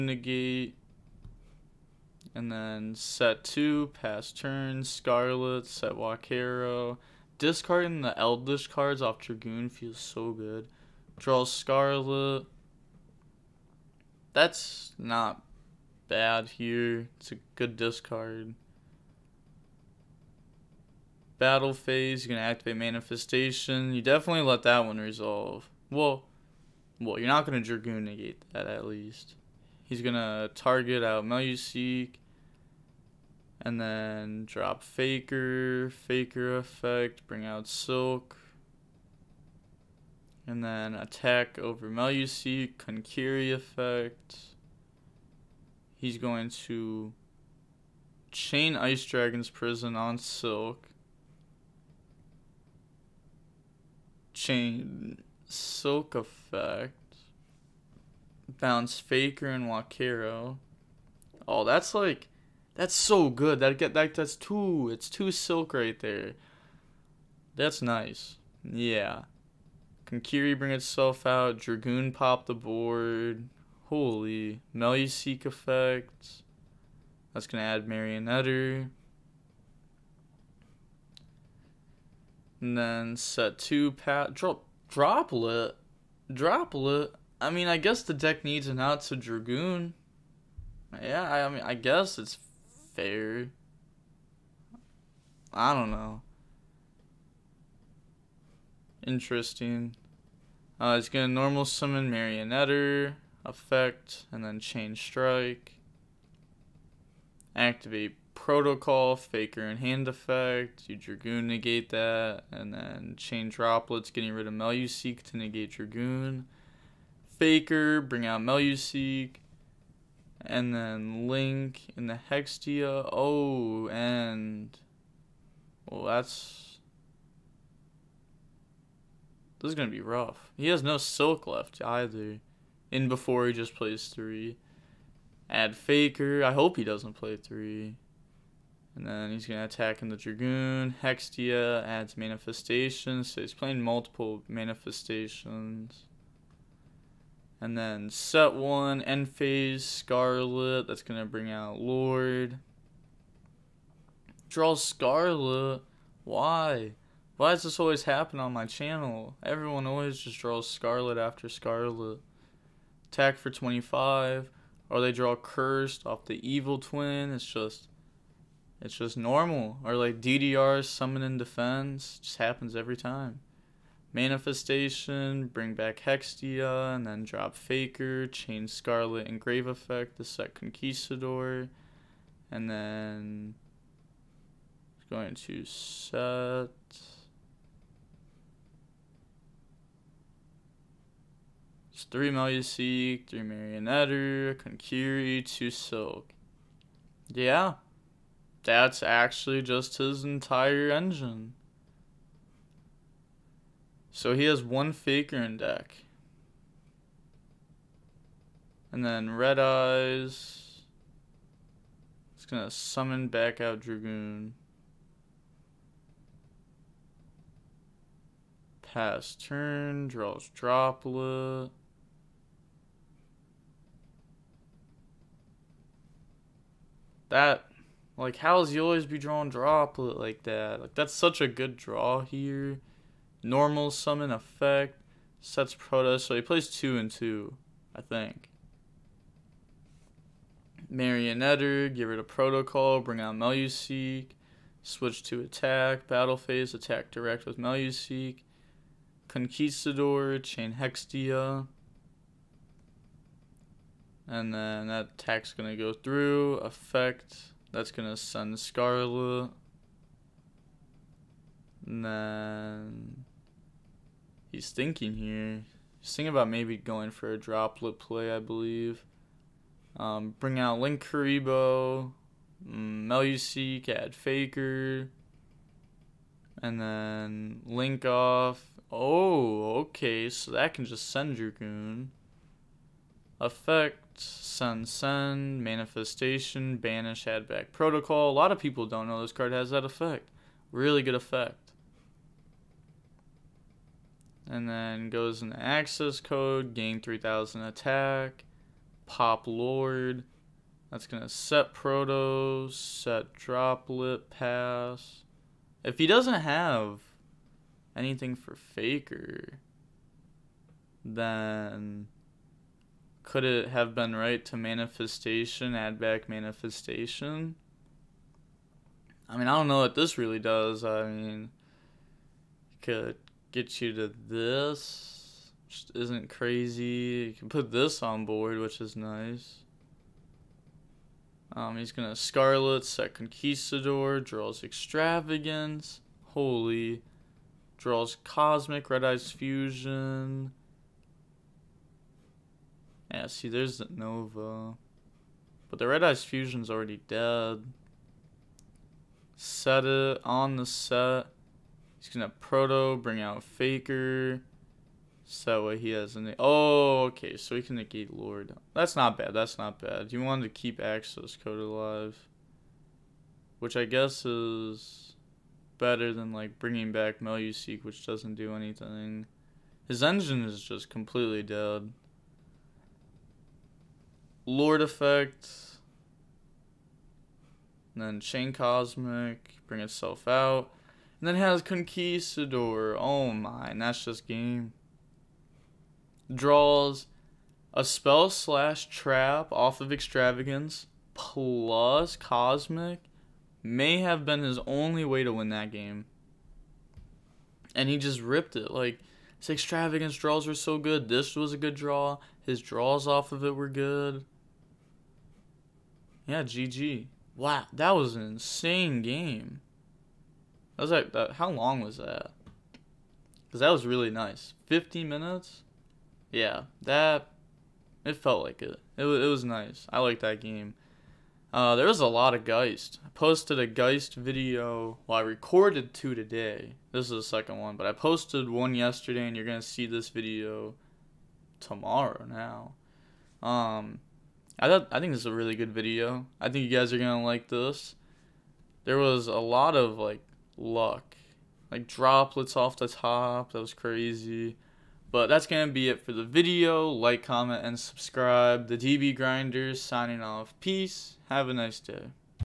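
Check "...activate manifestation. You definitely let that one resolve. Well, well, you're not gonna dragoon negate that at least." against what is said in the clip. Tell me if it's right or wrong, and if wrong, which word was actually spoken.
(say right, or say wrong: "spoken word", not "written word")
right.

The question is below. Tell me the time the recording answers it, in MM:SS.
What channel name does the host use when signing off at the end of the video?
07:28.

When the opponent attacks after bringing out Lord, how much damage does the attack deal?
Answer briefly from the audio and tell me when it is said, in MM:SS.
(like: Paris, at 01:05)
25, at 02:43.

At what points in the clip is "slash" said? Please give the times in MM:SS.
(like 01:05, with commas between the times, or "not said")
06:28.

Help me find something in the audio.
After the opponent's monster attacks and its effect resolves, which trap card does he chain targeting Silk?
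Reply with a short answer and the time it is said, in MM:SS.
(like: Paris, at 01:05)
Ice Dragon's prison, at 00:48.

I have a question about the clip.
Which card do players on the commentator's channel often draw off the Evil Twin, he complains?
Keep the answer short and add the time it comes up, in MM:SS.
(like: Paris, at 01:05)
Cursed, at 02:45.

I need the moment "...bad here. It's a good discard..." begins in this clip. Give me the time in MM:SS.
00:16.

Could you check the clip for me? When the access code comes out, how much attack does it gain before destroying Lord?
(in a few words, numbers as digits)
3000.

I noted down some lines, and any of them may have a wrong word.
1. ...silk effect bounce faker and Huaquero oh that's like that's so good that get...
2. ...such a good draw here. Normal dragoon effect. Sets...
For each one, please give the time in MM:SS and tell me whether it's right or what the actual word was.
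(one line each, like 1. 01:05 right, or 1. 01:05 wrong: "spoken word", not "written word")
1. 00:55 right
2. 03:51 wrong: "summon", not "dragoon".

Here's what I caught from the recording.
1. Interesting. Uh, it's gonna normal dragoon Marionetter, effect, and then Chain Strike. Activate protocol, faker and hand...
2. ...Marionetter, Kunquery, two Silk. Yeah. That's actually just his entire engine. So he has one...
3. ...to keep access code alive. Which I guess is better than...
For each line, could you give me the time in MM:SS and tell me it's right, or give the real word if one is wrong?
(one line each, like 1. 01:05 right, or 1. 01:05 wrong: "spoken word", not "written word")
1. 01:39 wrong: "summon", not "dragoon"
2. 03:13 right
3. 06:00 right.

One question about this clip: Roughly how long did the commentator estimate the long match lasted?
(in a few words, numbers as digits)
Fifteen minutes.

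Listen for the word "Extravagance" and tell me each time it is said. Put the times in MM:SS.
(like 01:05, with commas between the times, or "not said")
05:34, 06:29, 06:39.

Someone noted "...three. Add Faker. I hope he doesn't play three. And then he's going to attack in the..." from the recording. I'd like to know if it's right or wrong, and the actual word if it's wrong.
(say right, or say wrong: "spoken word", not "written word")
right.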